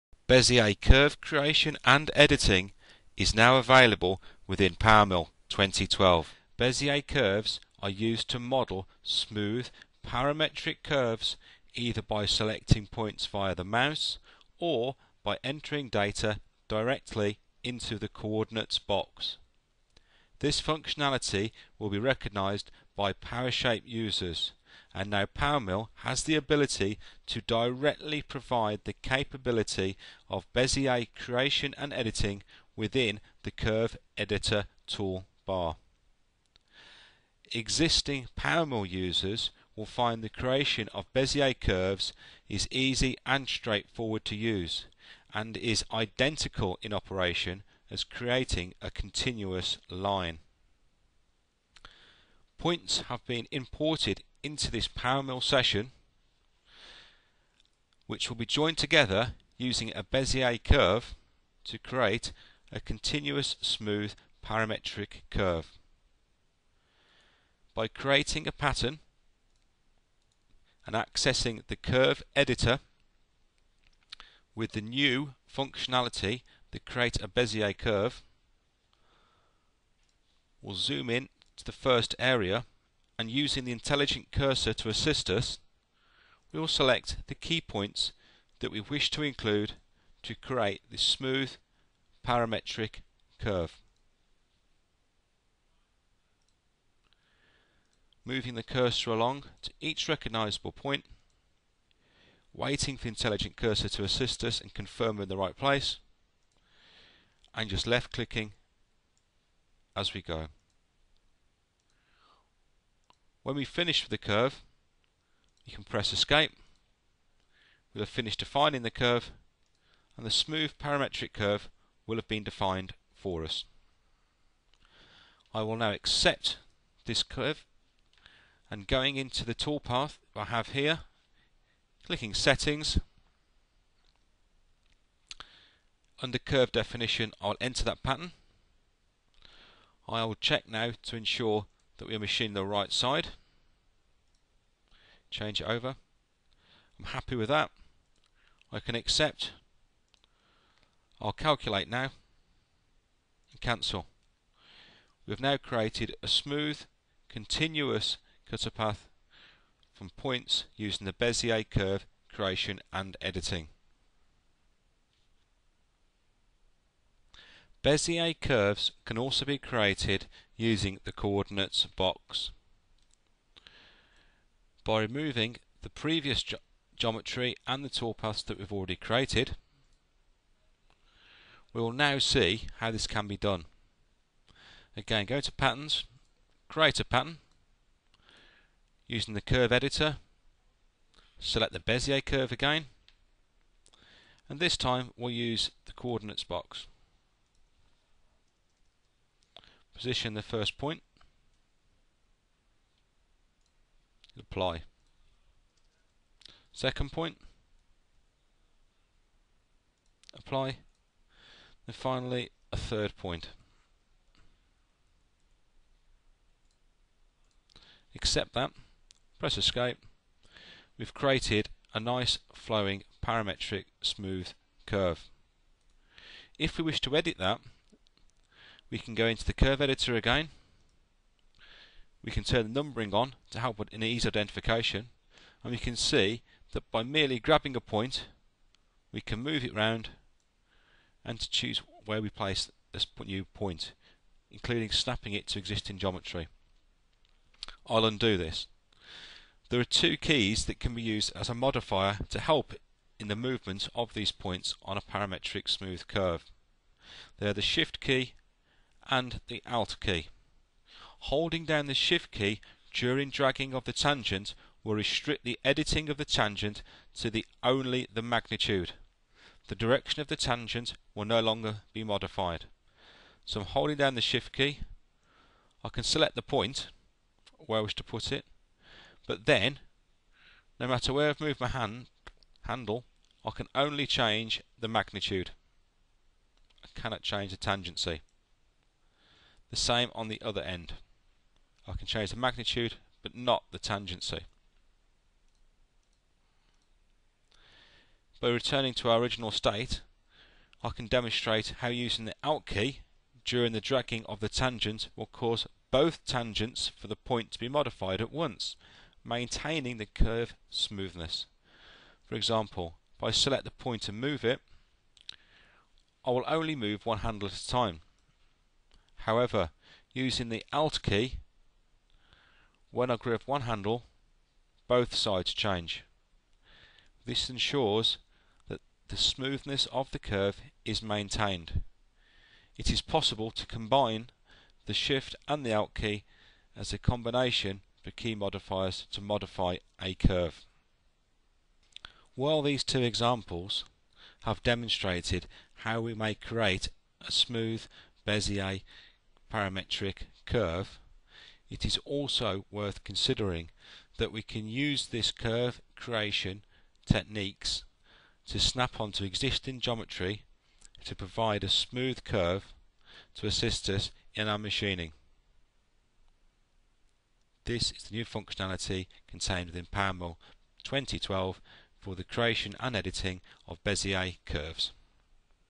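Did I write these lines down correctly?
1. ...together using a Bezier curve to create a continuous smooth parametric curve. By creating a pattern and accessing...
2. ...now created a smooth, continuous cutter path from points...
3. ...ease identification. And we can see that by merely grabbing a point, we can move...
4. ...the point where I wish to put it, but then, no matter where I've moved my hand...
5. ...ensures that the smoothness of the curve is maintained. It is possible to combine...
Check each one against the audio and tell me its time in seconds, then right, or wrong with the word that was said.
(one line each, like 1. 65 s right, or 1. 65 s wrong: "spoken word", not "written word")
1. 58 s right
2. 155 s right
3. 234 s right
4. 276 s right
5. 327 s right.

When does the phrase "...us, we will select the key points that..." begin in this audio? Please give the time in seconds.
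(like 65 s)
85 s.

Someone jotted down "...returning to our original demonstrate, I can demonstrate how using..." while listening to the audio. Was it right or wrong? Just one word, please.
wrong.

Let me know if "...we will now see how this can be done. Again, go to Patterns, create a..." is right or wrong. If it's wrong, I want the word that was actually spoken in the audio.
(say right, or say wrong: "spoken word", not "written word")
right.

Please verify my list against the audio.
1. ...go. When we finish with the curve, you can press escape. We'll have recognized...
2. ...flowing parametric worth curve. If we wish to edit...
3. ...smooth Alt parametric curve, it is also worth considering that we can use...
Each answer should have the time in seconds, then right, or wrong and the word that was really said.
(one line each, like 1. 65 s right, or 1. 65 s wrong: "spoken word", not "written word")
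1. 110 s wrong: "finished", not "recognized"
2. 222 s wrong: "smooth", not "worth"
3. 347 s wrong: "Bezier", not "Alt".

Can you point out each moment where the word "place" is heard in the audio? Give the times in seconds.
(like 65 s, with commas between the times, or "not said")
105 s, 242 s.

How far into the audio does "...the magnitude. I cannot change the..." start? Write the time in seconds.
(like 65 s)
284 s.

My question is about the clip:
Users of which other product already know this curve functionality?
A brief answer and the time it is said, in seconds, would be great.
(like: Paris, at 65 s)
PowerShape, at 23 s.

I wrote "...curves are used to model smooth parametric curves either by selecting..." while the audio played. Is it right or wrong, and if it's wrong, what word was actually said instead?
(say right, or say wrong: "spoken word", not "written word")
right.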